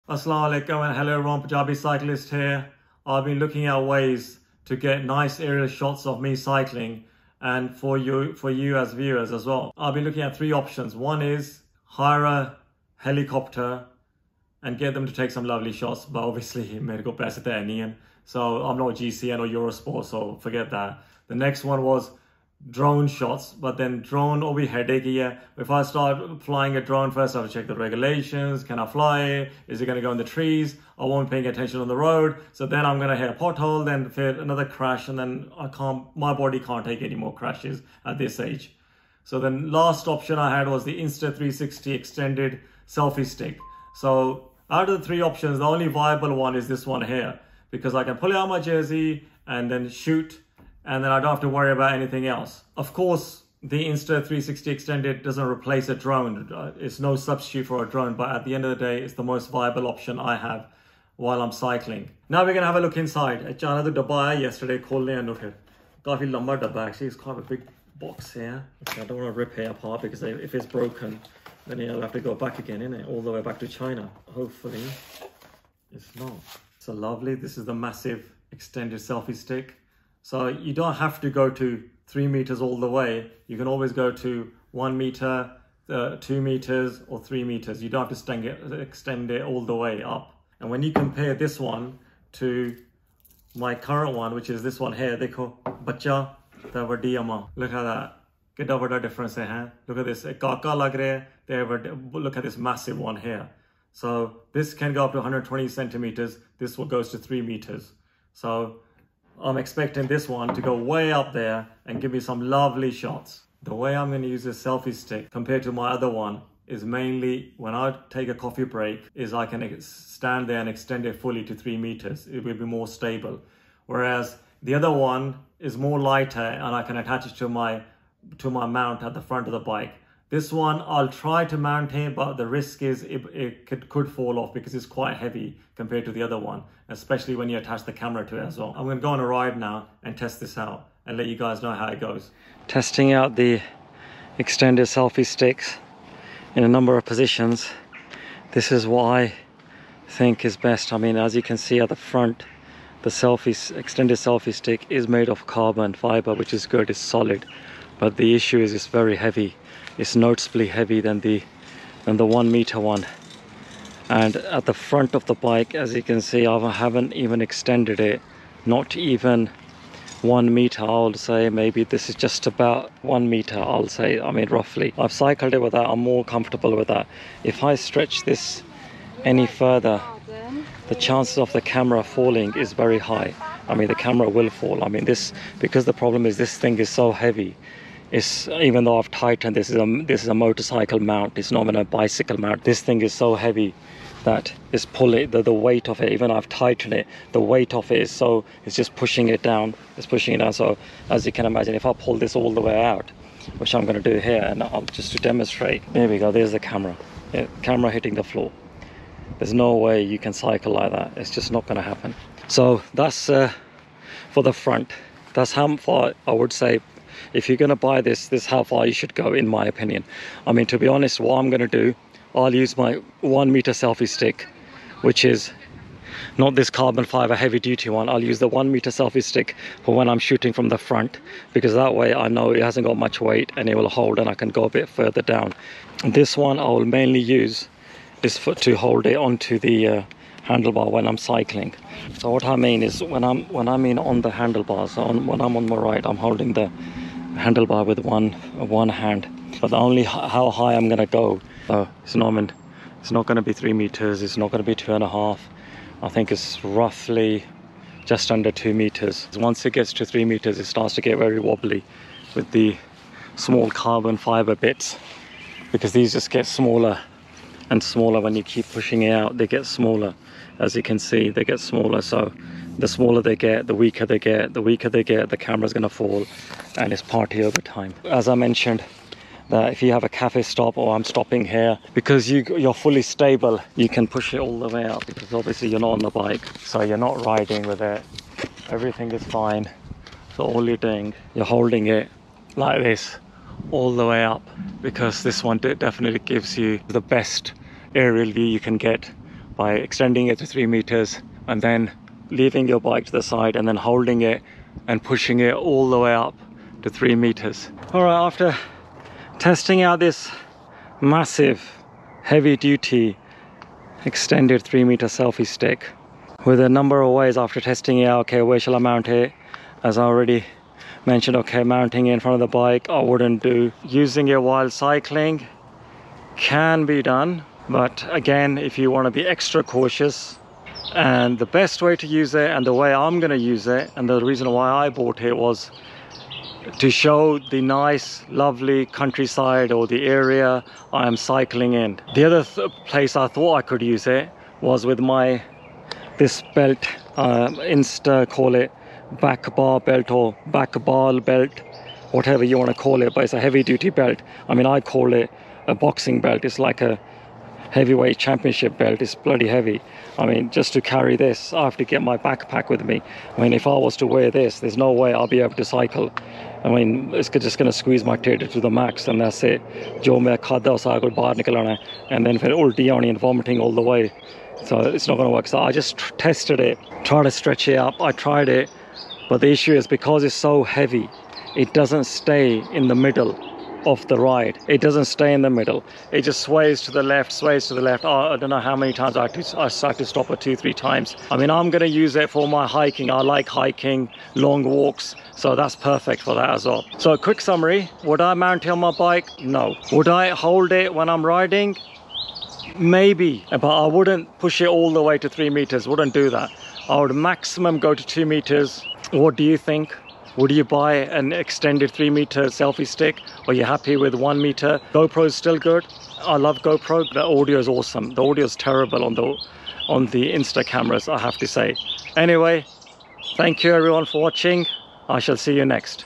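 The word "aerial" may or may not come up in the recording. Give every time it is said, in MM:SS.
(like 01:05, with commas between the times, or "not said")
00:05, 04:57.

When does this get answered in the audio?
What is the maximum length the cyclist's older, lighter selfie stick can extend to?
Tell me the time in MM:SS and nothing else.
01:45.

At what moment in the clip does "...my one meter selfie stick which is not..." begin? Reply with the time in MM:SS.
03:42.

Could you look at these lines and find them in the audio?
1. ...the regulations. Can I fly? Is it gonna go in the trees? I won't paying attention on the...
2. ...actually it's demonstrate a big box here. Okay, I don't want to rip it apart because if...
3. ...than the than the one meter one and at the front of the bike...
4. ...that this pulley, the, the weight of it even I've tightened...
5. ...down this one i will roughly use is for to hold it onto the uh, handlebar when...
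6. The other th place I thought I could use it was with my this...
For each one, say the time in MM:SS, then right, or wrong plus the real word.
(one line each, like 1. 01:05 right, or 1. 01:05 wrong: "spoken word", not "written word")
1. 00:27 right
2. 01:06 wrong: "quite", not "demonstrate"
3. 02:41 right
4. 03:14 right
5. 03:55 wrong: "mainly", not "roughly"
6. 05:42 right.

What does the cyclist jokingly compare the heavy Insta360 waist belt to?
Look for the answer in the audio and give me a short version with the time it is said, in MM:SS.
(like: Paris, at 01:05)
heavyweight championship belt, at 05:57.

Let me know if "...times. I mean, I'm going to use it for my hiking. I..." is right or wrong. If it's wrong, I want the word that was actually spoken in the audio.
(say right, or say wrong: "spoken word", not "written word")
right.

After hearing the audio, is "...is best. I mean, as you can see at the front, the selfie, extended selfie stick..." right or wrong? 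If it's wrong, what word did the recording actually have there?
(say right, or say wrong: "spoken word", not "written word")
right.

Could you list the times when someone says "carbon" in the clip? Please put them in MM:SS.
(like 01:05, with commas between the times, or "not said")
02:35, 03:46, 04:23.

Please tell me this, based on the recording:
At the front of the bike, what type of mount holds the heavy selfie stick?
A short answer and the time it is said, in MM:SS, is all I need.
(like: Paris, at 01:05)
motorcycle mount, at 03:10.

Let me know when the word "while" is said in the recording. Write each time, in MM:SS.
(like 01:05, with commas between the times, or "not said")
01:01, 05:24.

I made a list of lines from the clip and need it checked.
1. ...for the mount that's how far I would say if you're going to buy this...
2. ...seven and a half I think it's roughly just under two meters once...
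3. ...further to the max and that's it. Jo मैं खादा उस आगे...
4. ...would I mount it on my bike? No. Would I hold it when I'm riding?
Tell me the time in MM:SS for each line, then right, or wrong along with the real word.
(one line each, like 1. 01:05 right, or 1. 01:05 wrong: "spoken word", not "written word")
1. 03:34 wrong: "front", not "mount"
2. 04:14 wrong: "two", not "seven"
3. 06:08 wrong: "tater", not "further"
4. 06:38 right.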